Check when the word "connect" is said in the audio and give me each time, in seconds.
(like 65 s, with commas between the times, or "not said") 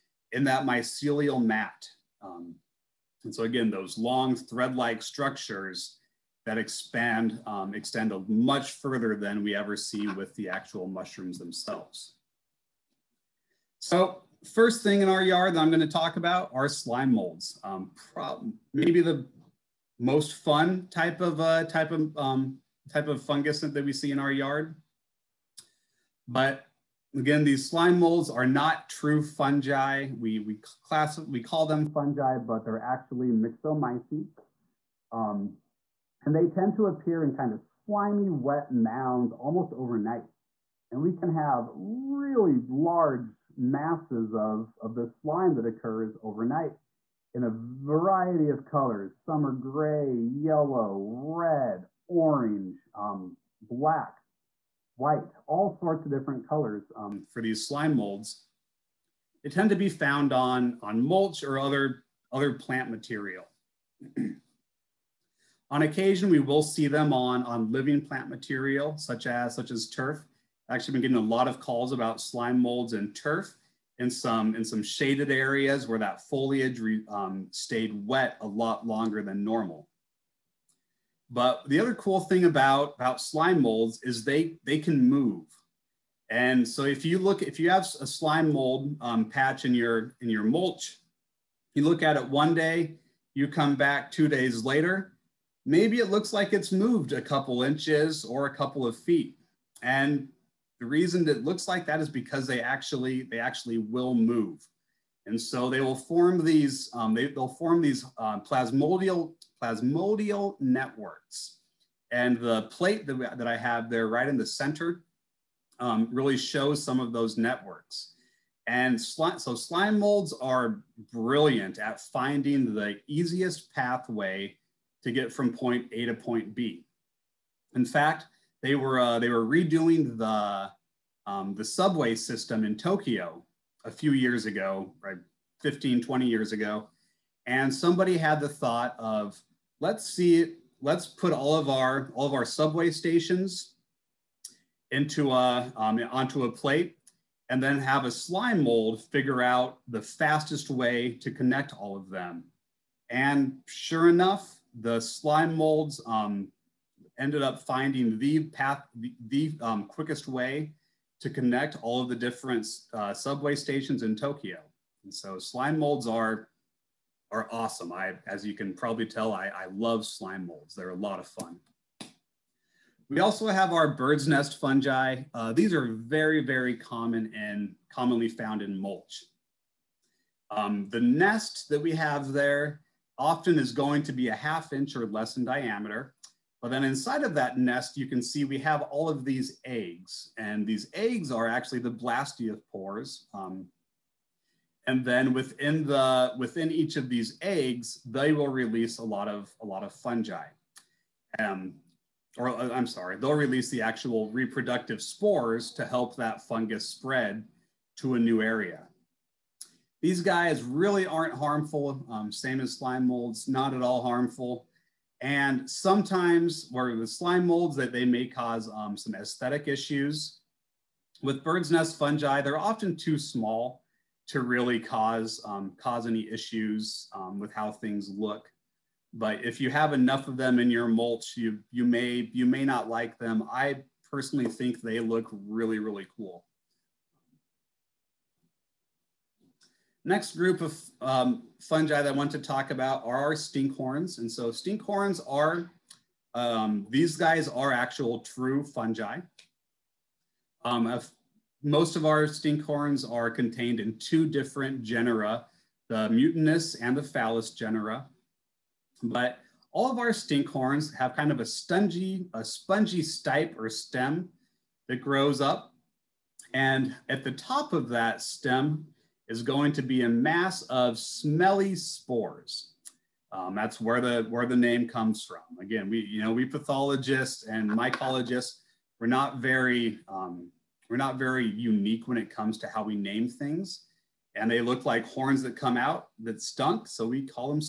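151 s, 161 s.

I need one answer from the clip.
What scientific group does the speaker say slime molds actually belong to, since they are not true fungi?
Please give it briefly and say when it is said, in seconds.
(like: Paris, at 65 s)
Myxomycetes, at 33 s.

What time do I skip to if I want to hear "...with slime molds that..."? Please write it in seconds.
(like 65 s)
216 s.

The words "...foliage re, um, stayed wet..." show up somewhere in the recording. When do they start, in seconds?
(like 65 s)
76 s.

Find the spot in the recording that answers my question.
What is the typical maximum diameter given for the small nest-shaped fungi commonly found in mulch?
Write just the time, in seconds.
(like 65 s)
184 s.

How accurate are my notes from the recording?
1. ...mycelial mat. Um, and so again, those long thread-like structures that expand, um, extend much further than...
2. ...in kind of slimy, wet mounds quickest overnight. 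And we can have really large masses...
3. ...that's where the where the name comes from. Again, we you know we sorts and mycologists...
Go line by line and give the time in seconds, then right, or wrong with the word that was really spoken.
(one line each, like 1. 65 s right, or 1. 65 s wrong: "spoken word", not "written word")
1. 0 s right
2. 37 s wrong: "almost", not "quickest"
3. 273 s wrong: "pathologists", not "sorts".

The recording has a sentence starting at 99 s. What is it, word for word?
And the reason that it looks like that is because they actually, they actually will move.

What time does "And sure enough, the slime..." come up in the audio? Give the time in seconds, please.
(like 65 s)
153 s.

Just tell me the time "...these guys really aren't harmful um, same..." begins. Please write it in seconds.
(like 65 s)
210 s.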